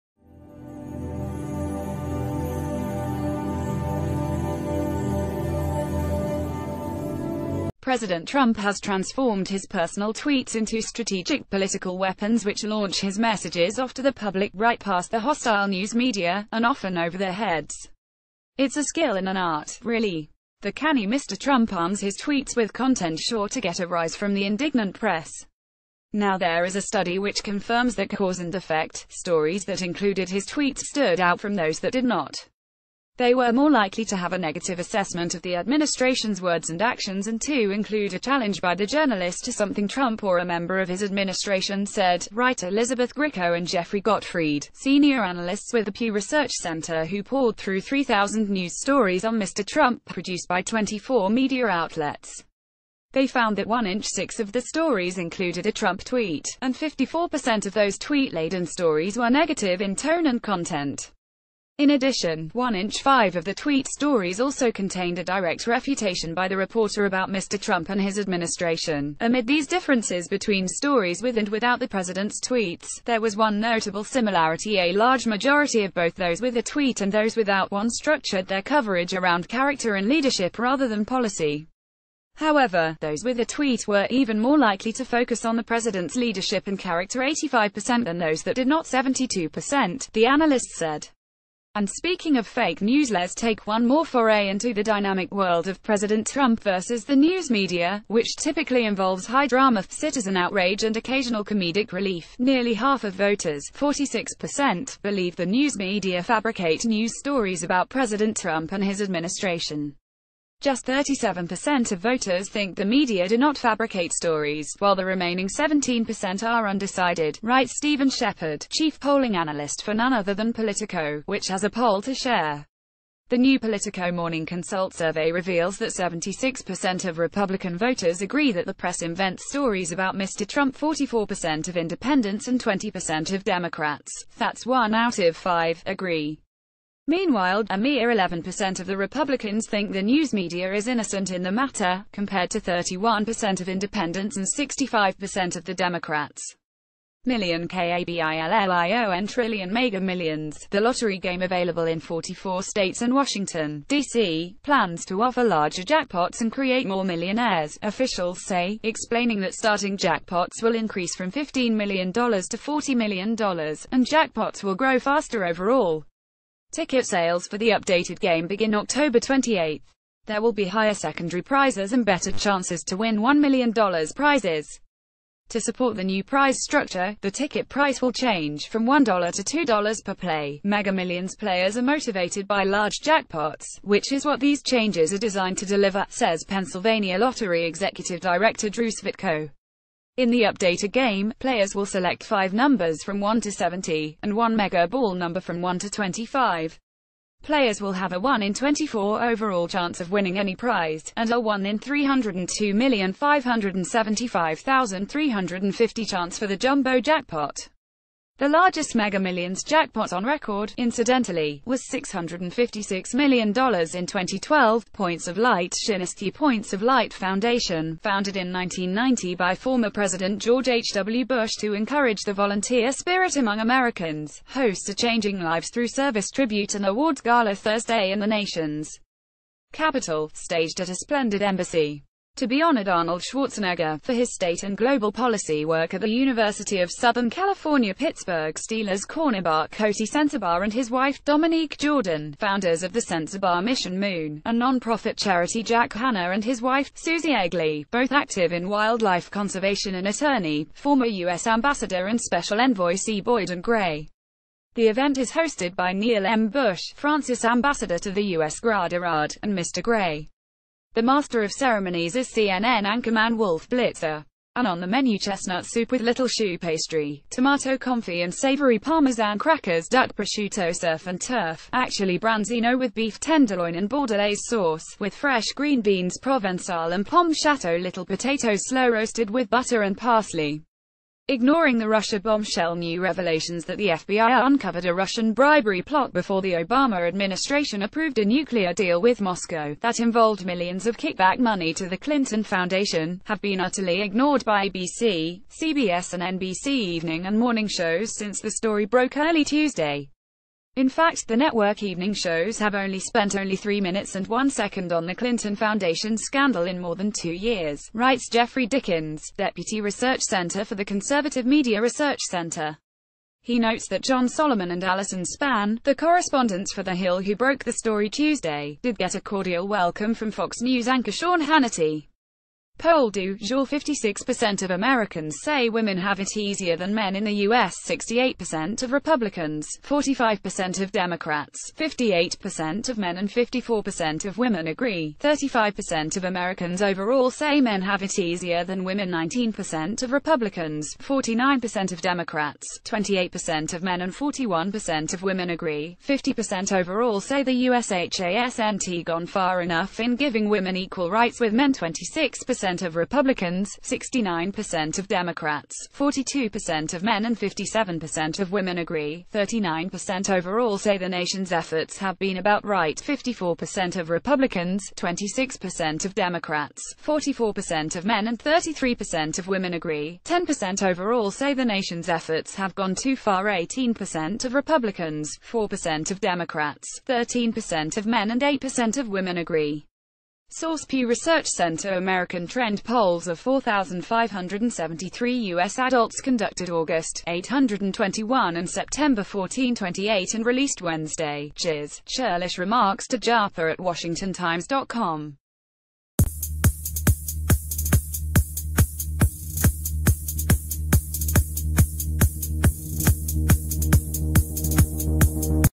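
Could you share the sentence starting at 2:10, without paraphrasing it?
Trump, 44% of independents and 20% of Democrats, that's one out of five, agree.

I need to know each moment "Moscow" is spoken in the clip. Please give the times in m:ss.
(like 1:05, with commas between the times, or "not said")
4:49.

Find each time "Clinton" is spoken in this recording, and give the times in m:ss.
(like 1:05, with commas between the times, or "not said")
4:51, 5:05.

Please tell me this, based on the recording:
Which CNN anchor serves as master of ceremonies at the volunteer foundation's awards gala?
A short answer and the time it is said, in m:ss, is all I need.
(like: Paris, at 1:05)
Wolf Blitzer, at 4:23.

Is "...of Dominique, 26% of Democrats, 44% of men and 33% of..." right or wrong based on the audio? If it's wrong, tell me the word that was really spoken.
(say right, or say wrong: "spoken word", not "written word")
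wrong: "Republicans", not "Dominique".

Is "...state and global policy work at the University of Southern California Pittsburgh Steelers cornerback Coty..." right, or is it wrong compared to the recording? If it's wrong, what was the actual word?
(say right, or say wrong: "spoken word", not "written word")
right.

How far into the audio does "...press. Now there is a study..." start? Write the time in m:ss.
0:24.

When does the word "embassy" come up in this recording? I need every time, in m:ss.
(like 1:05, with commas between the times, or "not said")
3:51.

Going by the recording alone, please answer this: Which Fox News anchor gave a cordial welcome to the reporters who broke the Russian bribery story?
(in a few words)
Sean Hannity.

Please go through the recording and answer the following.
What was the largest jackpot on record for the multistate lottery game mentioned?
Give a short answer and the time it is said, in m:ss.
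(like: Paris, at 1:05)
$656 million, at 3:31.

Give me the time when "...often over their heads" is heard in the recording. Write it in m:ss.
0:16.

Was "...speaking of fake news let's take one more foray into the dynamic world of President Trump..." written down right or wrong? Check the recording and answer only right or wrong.
right.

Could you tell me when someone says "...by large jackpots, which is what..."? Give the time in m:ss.
3:02.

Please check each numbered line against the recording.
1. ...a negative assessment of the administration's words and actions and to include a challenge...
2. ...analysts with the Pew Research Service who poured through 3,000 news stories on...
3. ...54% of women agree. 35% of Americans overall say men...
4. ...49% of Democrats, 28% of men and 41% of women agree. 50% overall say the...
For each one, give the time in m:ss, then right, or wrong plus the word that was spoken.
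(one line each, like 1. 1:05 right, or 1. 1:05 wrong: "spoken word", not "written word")
1. 0:34 right
2. 0:45 wrong: "Center", not "Service"
3. 5:33 right
4. 5:40 right.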